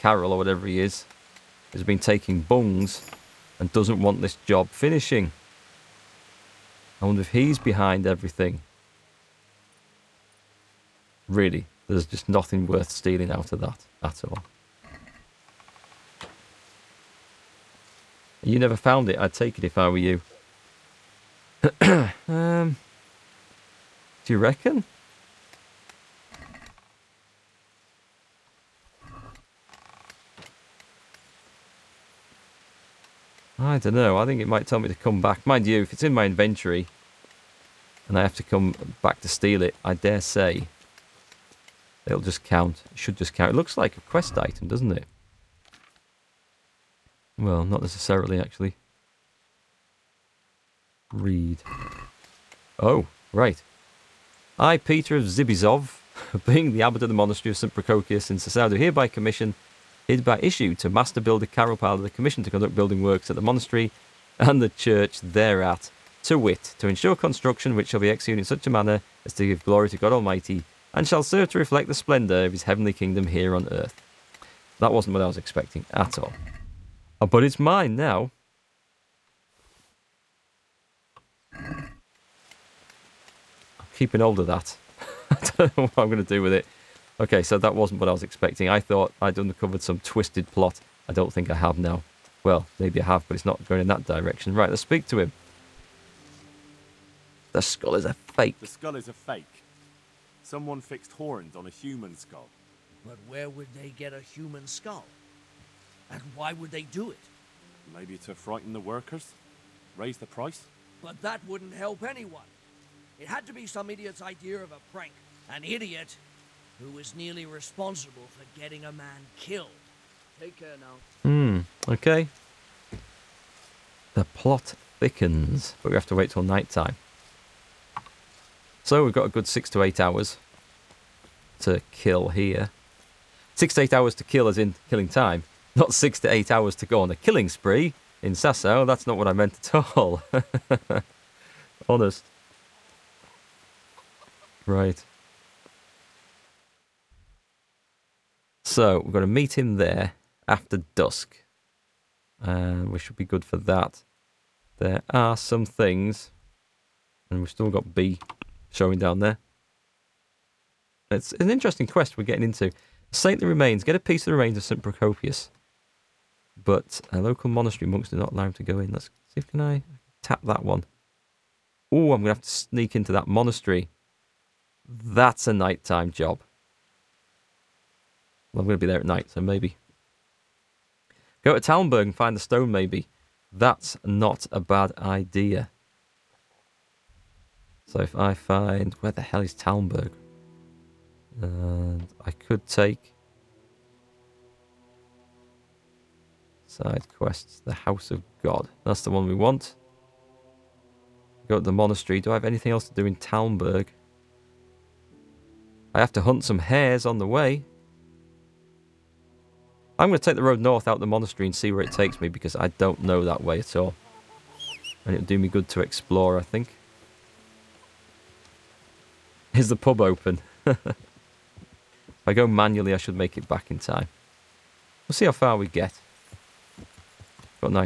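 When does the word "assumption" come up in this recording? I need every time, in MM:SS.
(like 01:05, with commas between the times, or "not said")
not said.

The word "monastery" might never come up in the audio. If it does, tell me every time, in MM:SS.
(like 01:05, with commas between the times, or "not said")
00:57, 01:03, 02:47, 02:53, 03:21, 03:31.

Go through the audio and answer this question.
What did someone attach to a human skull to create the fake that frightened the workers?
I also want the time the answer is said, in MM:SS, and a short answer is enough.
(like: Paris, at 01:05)
Horns, at 01:41.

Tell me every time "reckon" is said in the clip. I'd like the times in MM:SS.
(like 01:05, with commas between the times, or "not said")
00:24.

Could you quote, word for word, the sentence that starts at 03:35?
And it'll do me good to explore, I think.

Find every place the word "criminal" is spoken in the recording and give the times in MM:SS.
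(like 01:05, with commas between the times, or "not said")
not said.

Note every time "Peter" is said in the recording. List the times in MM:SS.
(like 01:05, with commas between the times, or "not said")
00:54.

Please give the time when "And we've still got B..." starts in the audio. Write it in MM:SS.
02:37.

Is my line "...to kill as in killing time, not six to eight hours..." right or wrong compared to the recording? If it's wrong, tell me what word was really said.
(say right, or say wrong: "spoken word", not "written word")
right.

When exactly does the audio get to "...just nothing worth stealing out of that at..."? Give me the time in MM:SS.
00:12.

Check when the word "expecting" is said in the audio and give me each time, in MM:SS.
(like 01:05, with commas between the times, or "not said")
01:15, 01:28.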